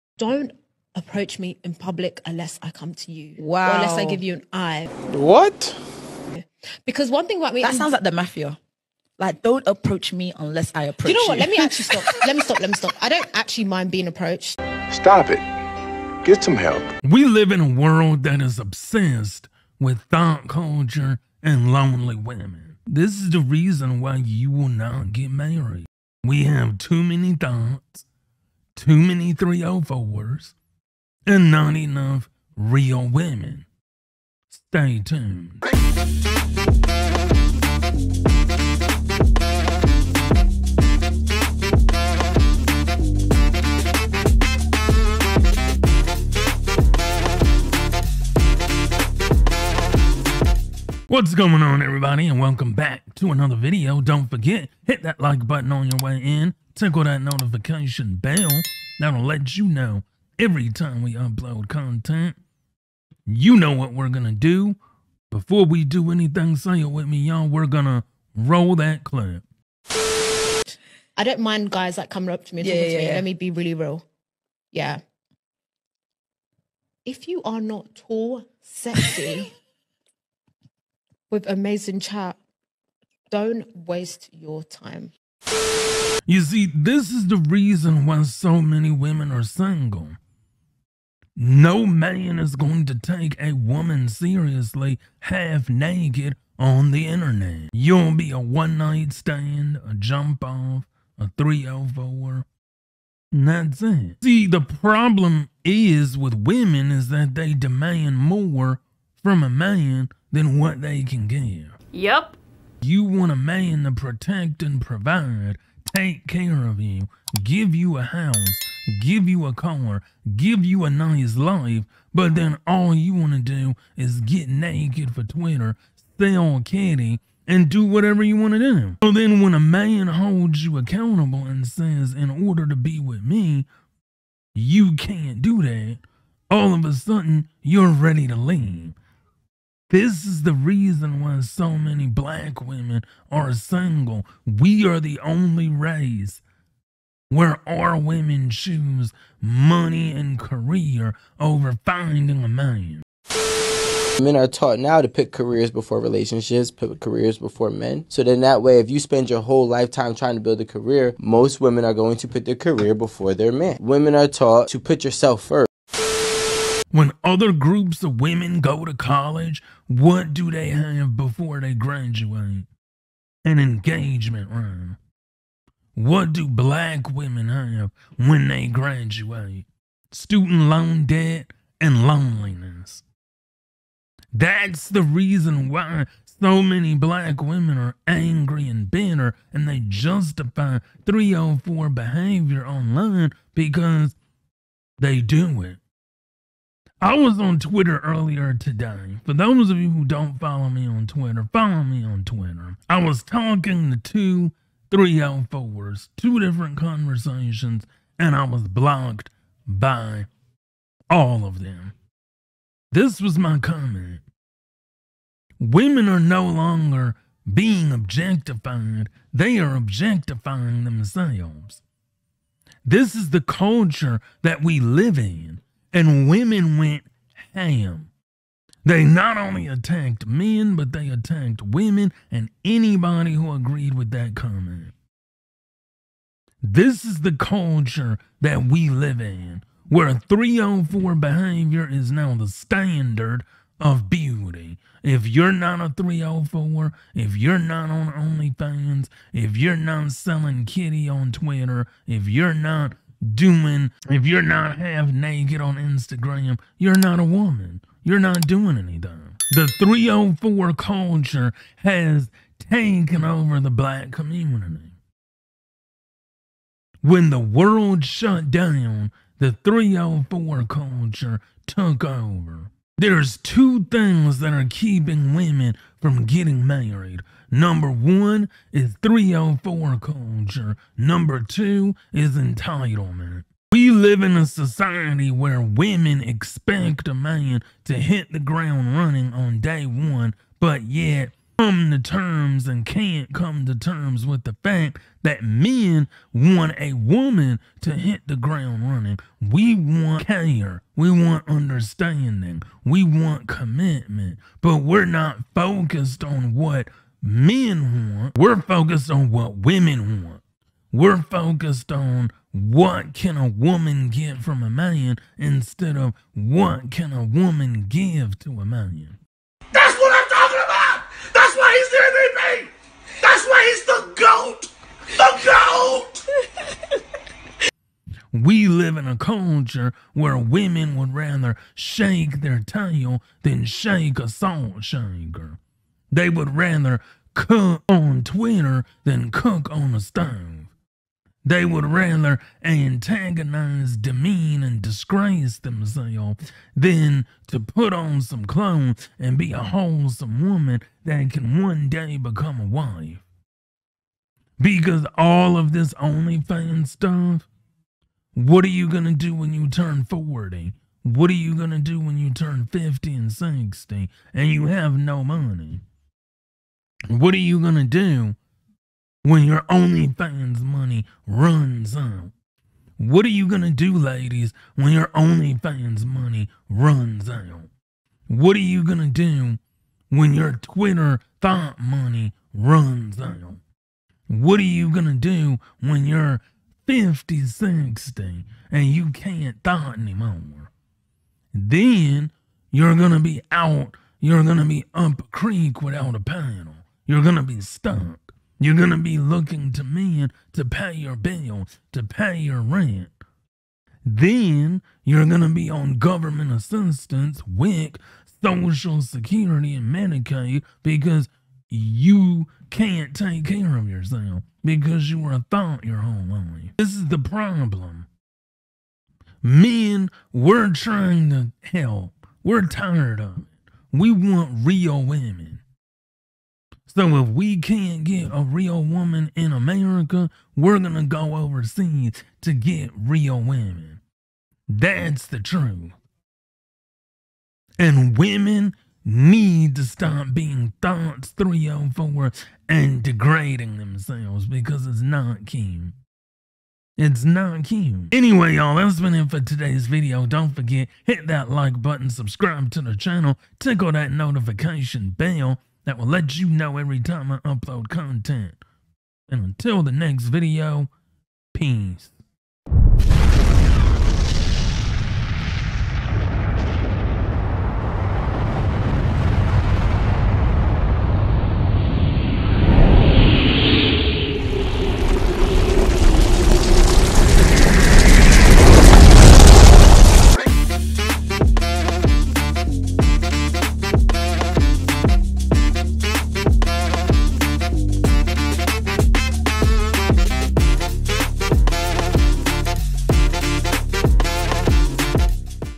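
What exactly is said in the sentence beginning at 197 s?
I was on Twitter earlier today.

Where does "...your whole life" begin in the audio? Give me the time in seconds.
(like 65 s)
415 s.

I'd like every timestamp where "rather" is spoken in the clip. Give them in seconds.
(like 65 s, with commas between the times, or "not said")
331 s, 336 s, 341 s.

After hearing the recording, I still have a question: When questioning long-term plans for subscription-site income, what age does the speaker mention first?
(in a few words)
40.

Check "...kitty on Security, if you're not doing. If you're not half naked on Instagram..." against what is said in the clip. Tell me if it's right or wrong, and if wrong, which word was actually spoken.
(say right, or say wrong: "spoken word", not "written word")
wrong: "Twitter", not "Security".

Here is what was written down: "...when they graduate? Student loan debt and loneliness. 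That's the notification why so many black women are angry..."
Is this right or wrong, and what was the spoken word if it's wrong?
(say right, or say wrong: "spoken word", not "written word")
wrong: "reason", not "notification".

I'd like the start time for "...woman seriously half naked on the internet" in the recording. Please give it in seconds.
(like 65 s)
93 s.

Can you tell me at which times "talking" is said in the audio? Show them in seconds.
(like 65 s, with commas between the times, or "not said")
72 s, 203 s.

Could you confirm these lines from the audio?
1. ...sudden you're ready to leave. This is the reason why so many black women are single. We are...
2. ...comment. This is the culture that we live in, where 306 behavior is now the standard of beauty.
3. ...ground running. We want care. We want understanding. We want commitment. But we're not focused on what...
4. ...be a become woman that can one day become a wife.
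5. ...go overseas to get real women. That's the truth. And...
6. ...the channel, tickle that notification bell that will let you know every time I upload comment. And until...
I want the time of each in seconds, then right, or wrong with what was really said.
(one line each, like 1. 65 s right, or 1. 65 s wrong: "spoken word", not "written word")
1. 136 s right
2. 234 s wrong: "304", not "306"
3. 298 s right
4. 349 s wrong: "wholesome", not "become"
5. 431 s right
6. 452 s wrong: "content", not "comment".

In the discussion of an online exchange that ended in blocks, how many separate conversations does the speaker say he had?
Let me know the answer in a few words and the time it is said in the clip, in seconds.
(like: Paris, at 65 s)
2, at 206 s.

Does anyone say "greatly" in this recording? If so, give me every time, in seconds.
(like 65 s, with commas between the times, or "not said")
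not said.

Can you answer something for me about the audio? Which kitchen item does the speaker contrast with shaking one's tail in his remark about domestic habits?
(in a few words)
salt shaker.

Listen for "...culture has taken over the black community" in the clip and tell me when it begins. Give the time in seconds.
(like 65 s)
260 s.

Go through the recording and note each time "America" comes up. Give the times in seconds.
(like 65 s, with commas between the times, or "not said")
429 s.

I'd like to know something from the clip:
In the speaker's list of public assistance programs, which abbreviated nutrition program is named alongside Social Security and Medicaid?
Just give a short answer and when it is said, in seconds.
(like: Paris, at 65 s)
WIC, at 407 s.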